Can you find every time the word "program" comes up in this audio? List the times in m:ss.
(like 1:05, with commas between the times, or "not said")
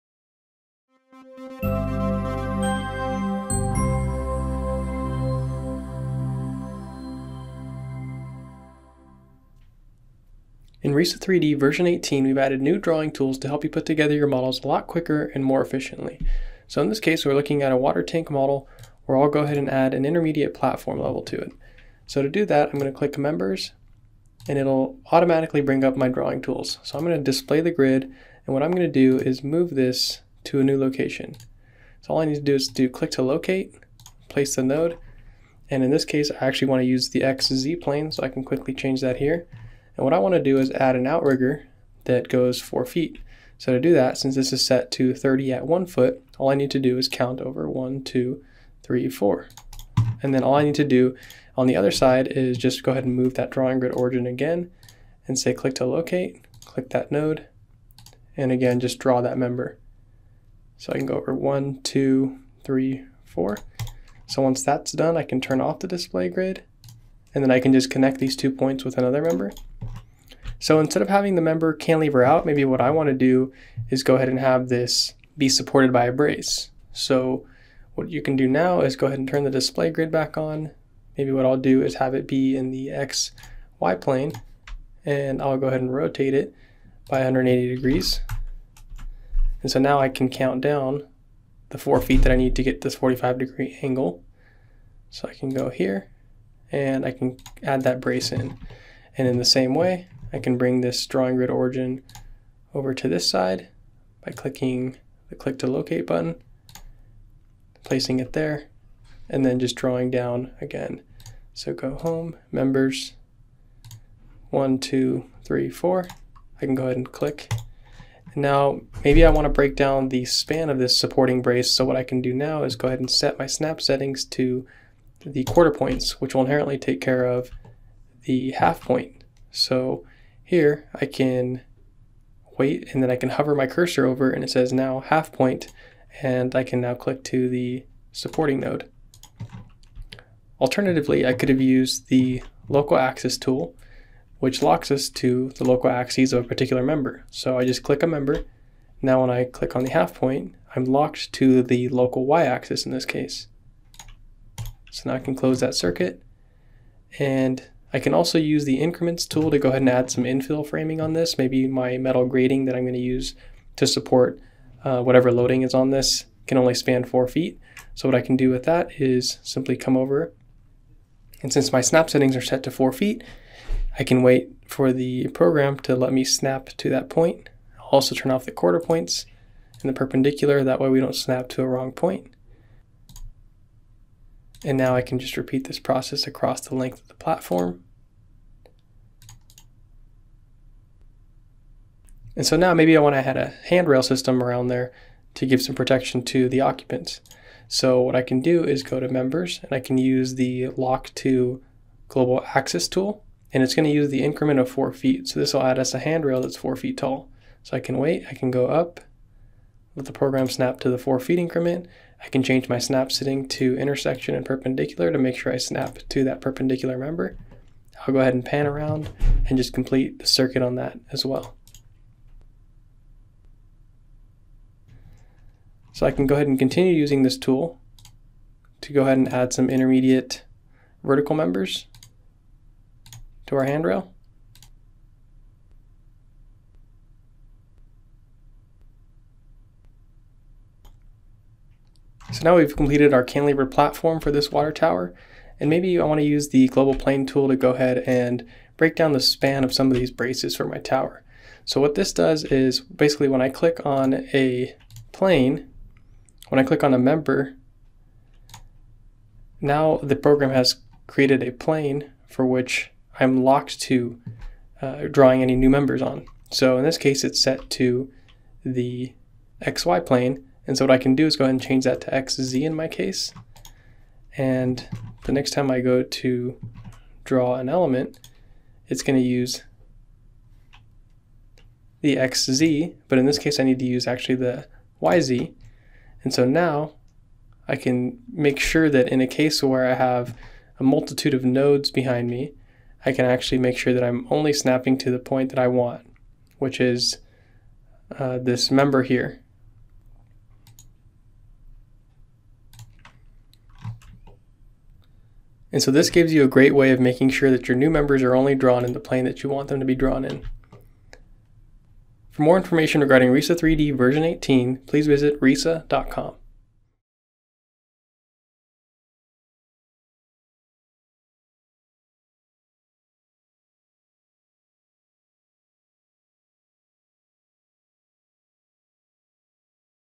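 2:55, 3:30, 4:20.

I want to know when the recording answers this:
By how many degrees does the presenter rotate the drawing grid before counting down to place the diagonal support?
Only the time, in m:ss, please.
1:27.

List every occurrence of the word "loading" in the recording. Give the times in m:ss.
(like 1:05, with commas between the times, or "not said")
2:45.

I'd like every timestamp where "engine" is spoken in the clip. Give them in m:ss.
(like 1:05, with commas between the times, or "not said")
not said.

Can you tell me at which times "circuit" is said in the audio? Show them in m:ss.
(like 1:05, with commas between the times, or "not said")
2:35, 3:40.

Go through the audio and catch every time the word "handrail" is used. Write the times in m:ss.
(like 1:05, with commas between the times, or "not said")
3:13, 3:25, 3:53.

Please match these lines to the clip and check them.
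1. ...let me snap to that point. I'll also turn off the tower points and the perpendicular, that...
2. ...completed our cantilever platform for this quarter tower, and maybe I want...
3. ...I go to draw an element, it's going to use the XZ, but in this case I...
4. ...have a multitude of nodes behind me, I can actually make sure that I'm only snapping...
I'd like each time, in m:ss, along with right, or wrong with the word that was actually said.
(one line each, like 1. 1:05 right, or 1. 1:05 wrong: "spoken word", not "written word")
1. 2:55 wrong: "quarter", not "tower"
2. 4:02 wrong: "water", not "quarter"
3. 4:35 right
4. 4:49 right.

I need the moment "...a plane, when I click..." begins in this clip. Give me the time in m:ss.
4:14.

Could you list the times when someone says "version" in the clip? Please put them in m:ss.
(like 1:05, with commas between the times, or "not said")
0:11, 5:13.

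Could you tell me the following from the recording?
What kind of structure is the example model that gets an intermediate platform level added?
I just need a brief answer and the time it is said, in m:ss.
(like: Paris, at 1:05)
Water tank, at 0:17.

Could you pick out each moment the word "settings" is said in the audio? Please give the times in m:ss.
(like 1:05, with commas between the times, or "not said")
2:03, 2:52.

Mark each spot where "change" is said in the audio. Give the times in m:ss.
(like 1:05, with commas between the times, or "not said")
0:38, 3:32, 4:31.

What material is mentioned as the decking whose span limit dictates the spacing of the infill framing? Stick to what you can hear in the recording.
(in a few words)
Metal grating.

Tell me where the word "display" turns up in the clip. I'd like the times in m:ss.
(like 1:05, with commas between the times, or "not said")
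0:27, 1:05, 1:19.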